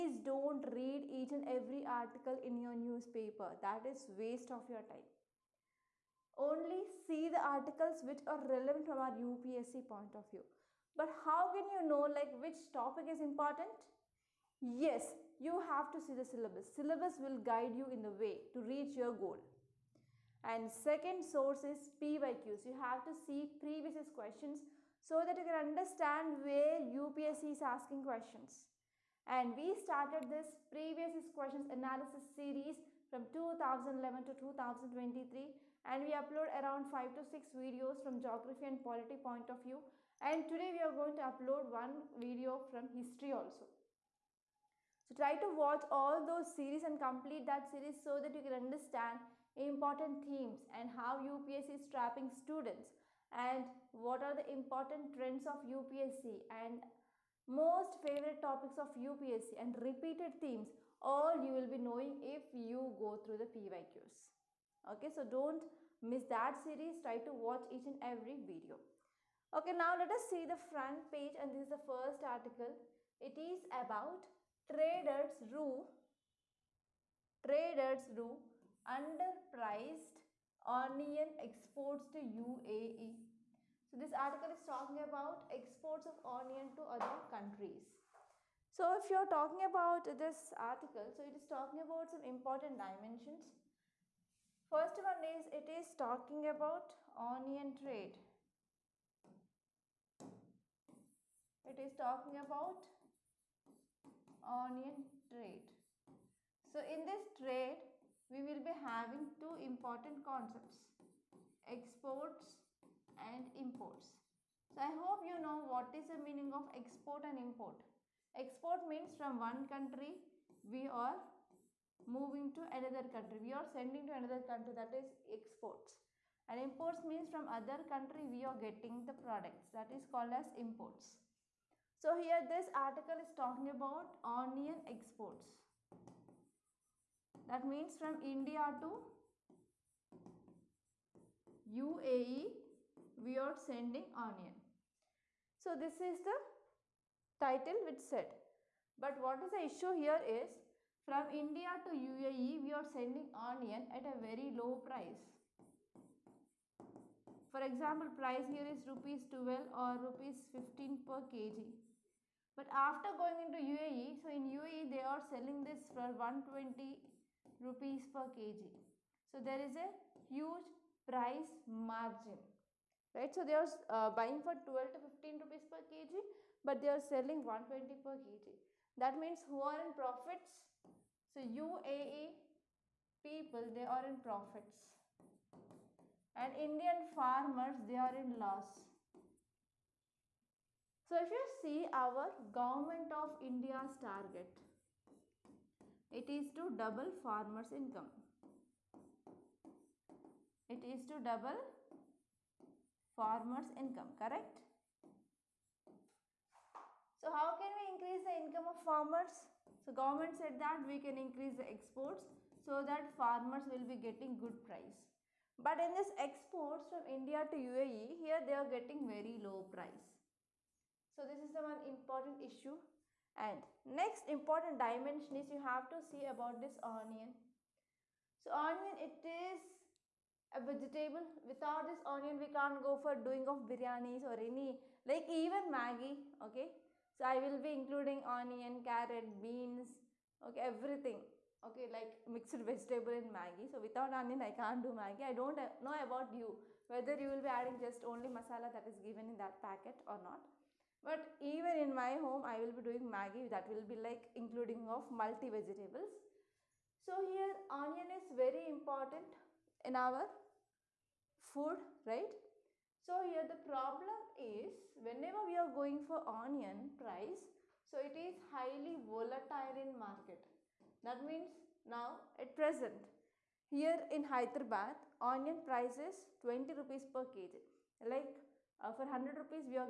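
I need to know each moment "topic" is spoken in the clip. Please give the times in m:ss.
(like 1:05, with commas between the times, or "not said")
0:12, 0:58.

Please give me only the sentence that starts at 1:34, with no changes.
First one is it is talking about onion trade.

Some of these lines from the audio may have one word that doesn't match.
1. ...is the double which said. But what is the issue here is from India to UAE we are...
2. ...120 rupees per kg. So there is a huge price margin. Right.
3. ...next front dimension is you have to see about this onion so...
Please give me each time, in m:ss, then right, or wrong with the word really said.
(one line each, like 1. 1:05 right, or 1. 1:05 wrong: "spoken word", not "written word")
1. 2:26 wrong: "title", not "double"
2. 2:46 right
3. 3:43 wrong: "important", not "front".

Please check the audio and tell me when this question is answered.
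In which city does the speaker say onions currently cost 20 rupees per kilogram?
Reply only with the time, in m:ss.
4:34.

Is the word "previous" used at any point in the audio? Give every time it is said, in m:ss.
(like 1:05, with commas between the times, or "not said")
0:23, 0:30.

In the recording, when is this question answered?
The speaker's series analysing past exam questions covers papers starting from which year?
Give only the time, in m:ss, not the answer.
0:33.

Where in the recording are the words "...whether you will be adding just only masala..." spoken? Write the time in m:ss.
4:06.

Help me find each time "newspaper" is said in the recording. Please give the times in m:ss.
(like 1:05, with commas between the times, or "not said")
0:02.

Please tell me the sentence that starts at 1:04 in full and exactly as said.
Okay, so don't miss that series.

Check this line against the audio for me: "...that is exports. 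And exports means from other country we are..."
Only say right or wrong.
wrong.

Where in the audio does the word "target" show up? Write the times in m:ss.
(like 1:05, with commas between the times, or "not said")
3:13.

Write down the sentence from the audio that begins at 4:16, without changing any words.
So here onion is very important in our food, right?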